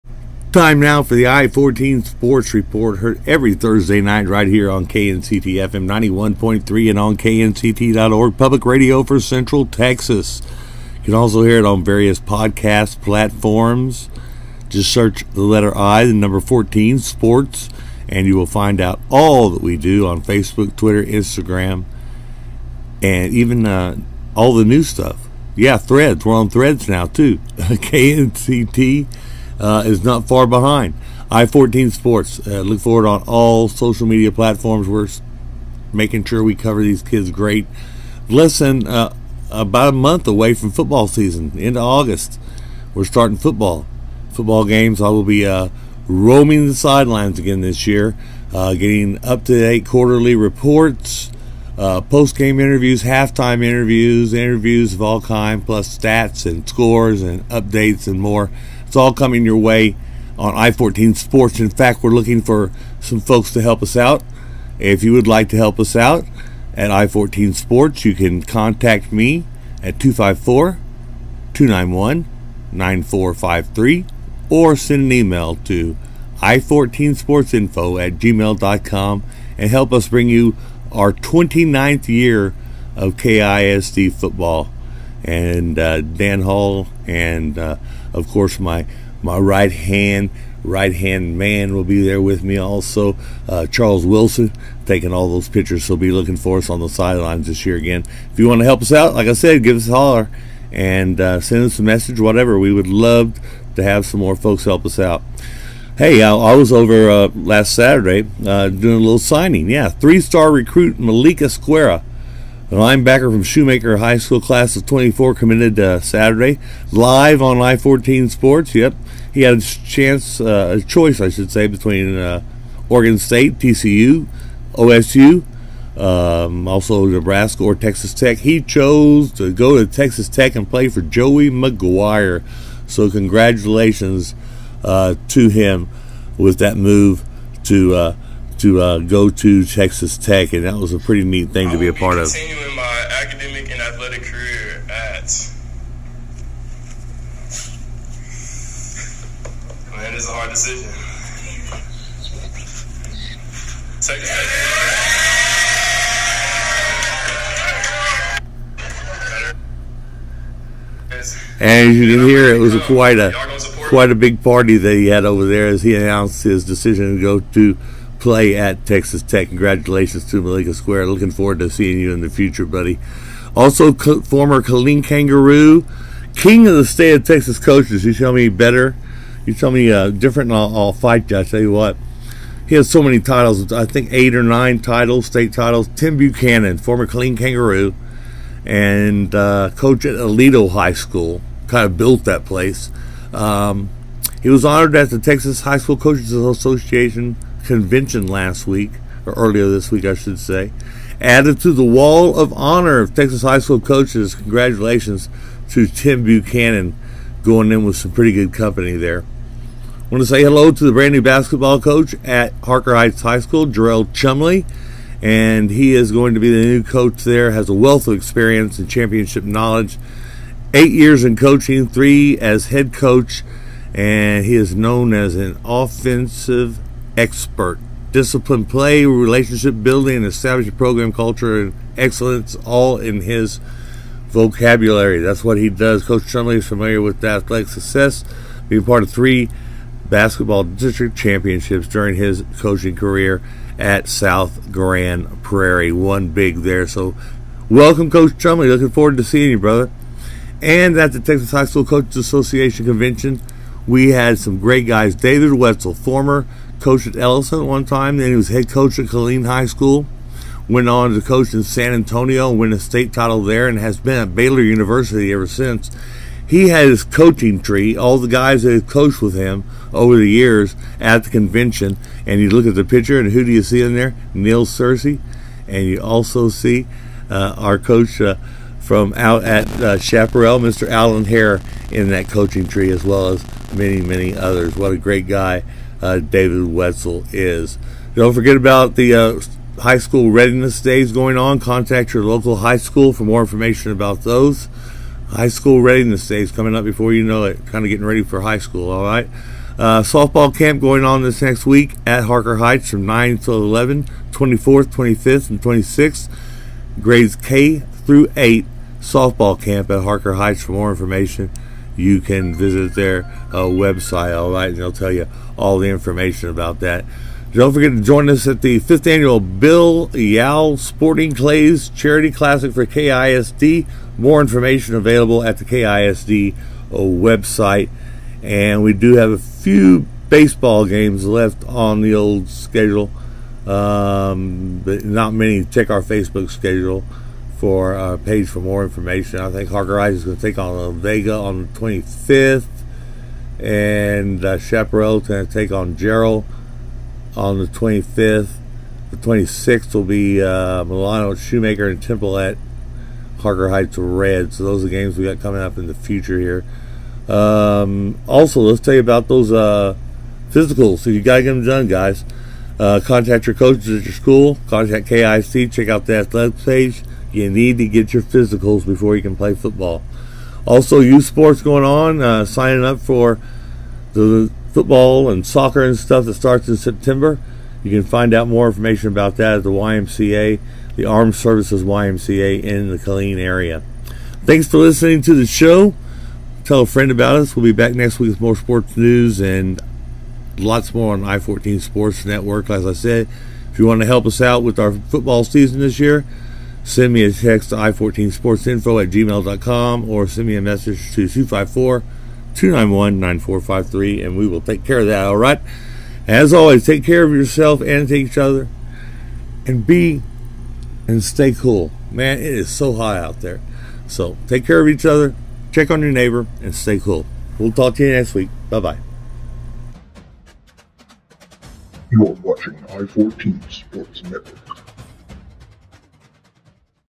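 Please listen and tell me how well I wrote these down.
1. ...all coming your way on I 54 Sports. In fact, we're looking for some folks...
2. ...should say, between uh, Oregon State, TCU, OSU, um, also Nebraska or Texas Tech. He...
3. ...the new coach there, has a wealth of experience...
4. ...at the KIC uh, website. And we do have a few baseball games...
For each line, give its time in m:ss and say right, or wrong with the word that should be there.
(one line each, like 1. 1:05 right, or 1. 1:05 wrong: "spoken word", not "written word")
1. 0:58 wrong: "14", not "54"
2. 2:01 right
3. 3:36 right
4. 5:25 wrong: "KISD", not "KIC".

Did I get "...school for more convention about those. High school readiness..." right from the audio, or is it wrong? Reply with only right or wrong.
wrong.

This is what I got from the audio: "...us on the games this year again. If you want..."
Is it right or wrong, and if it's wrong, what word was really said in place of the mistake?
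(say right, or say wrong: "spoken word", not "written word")
wrong: "sidelines", not "games".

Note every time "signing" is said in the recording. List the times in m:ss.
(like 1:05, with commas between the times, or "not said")
1:49, 6:12.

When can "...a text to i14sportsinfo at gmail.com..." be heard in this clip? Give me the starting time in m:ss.
6:37.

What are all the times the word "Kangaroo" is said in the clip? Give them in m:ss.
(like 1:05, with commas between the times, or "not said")
2:55, 3:07.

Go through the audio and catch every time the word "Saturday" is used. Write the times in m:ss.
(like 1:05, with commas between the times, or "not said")
1:47, 1:55.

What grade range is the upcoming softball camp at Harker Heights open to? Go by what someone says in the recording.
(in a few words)
K through 8.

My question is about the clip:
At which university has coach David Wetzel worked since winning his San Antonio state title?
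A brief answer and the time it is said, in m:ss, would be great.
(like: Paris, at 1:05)
Baylor University, at 4:24.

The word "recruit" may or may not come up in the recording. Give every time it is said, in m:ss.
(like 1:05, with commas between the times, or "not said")
1:50.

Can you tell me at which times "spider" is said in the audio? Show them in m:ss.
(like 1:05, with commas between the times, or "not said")
not said.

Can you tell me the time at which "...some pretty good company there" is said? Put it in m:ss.
3:27.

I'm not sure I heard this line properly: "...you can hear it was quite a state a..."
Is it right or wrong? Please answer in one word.
wrong.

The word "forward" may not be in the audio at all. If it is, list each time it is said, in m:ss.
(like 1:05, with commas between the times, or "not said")
0:32, 2:51, 4:08.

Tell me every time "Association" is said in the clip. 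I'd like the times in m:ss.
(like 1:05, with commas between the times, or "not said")
3:16, 4:12.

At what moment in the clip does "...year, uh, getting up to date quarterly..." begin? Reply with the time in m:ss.
0:47.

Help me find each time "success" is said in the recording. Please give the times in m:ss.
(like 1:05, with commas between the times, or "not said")
3:57.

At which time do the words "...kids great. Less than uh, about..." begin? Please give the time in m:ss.
0:37.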